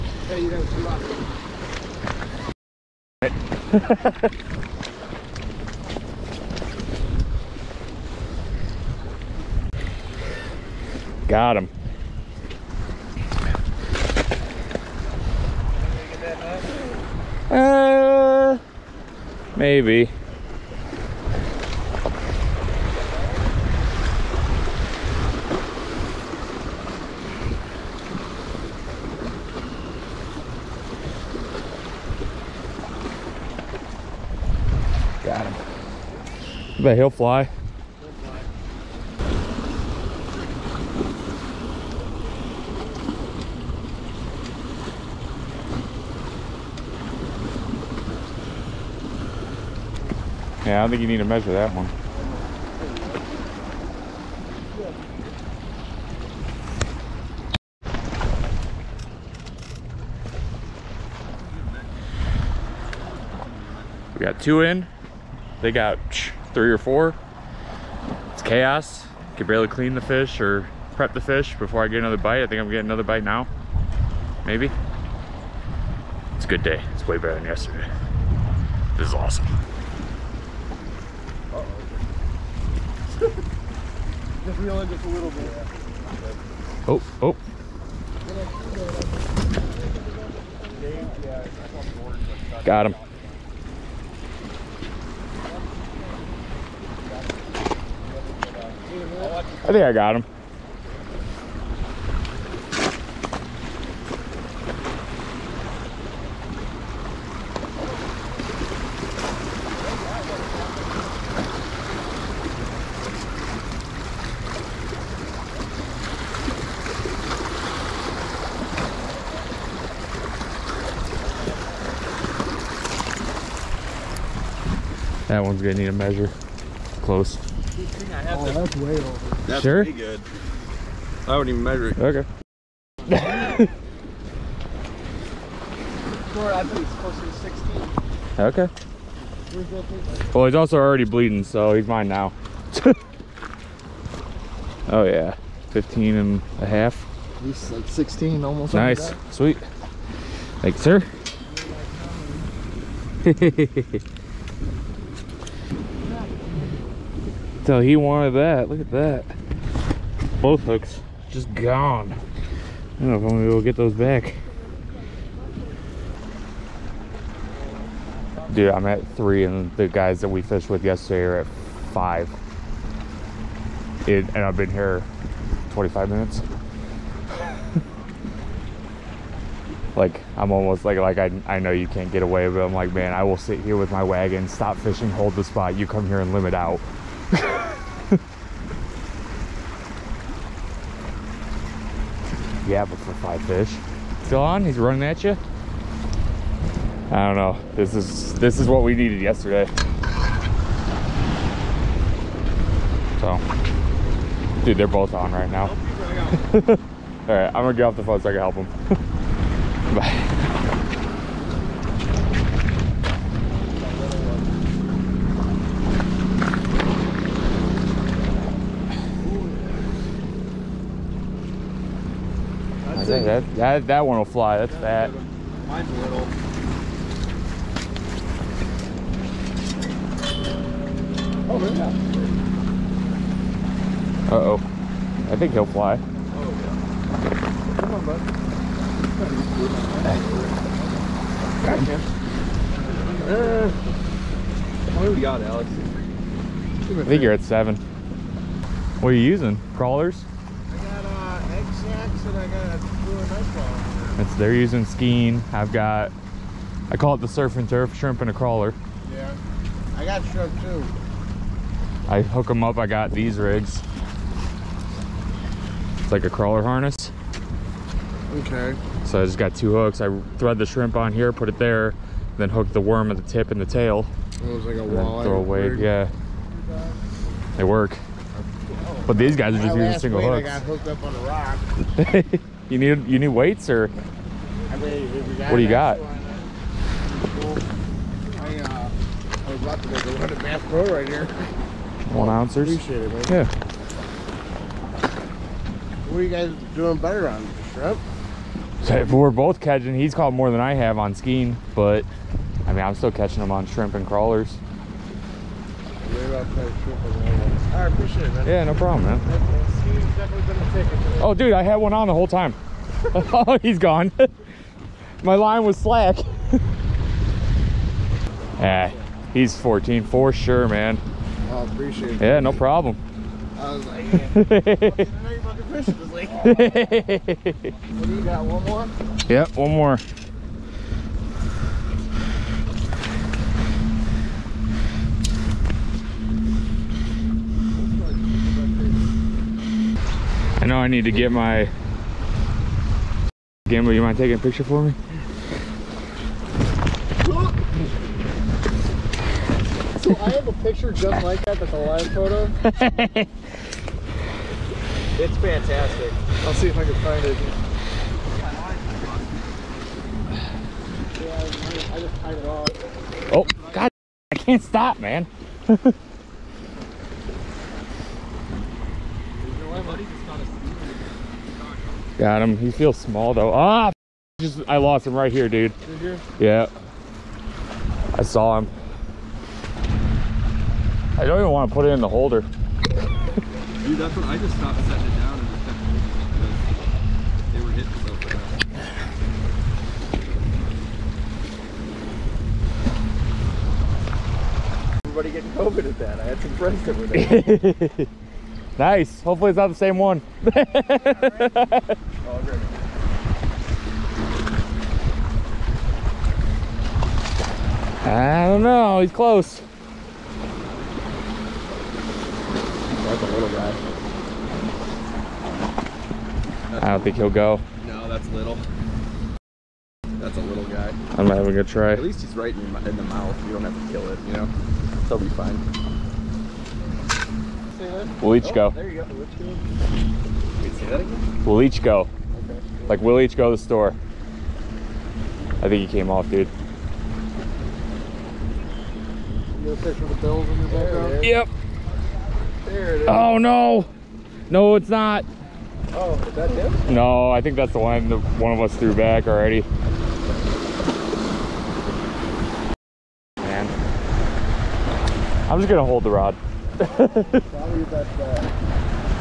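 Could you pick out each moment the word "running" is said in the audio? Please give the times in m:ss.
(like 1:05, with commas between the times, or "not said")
3:14.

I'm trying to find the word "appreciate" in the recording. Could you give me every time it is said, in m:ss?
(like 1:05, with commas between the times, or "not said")
4:52, 5:07, 5:21.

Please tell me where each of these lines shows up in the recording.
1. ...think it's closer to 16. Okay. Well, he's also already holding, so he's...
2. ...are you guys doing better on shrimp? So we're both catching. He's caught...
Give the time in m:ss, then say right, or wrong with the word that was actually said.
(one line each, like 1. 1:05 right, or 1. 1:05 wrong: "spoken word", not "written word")
1. 2:16 wrong: "bleeding", not "holding"
2. 4:56 right.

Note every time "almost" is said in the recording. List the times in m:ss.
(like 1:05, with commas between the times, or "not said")
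2:28, 3:00.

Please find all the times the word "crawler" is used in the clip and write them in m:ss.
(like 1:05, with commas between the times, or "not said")
4:09, 4:18, 4:26, 5:04.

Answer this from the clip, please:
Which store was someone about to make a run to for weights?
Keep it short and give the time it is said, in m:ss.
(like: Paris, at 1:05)
Bass Pro, at 4:50.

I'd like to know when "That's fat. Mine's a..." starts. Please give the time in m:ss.
3:44.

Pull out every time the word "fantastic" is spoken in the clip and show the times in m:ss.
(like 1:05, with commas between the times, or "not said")
5:55.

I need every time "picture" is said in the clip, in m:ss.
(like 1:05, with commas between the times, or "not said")
5:44, 5:50, 7:19.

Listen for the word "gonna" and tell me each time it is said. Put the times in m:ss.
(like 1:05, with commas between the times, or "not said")
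2:05, 2:43, 3:27.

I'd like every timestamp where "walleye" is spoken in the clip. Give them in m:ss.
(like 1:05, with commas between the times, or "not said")
4:34.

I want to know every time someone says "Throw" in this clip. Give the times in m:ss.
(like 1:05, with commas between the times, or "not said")
4:35.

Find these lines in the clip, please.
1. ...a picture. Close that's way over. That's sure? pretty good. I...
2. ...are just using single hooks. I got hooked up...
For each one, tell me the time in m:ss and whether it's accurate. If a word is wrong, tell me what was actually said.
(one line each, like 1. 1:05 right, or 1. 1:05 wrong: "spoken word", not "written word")
1. 2:05 wrong: "measure", not "picture"
2. 4:39 right.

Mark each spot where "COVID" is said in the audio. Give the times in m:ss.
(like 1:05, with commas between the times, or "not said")
6:35.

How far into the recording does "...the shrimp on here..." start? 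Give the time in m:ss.
4:30.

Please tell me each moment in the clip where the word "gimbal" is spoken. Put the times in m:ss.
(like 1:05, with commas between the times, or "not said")
5:43.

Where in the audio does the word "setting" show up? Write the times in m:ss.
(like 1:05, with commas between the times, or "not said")
6:24.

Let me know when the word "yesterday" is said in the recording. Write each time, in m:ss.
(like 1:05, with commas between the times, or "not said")
1:17, 2:50, 3:19.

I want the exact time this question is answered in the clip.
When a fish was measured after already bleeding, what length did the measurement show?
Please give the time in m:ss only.
2:25.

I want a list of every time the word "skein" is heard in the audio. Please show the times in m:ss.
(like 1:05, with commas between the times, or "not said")
4:14, 5:01.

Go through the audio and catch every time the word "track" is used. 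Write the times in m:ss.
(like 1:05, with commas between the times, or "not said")
not said.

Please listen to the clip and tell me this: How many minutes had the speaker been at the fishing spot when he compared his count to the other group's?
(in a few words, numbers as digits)
25.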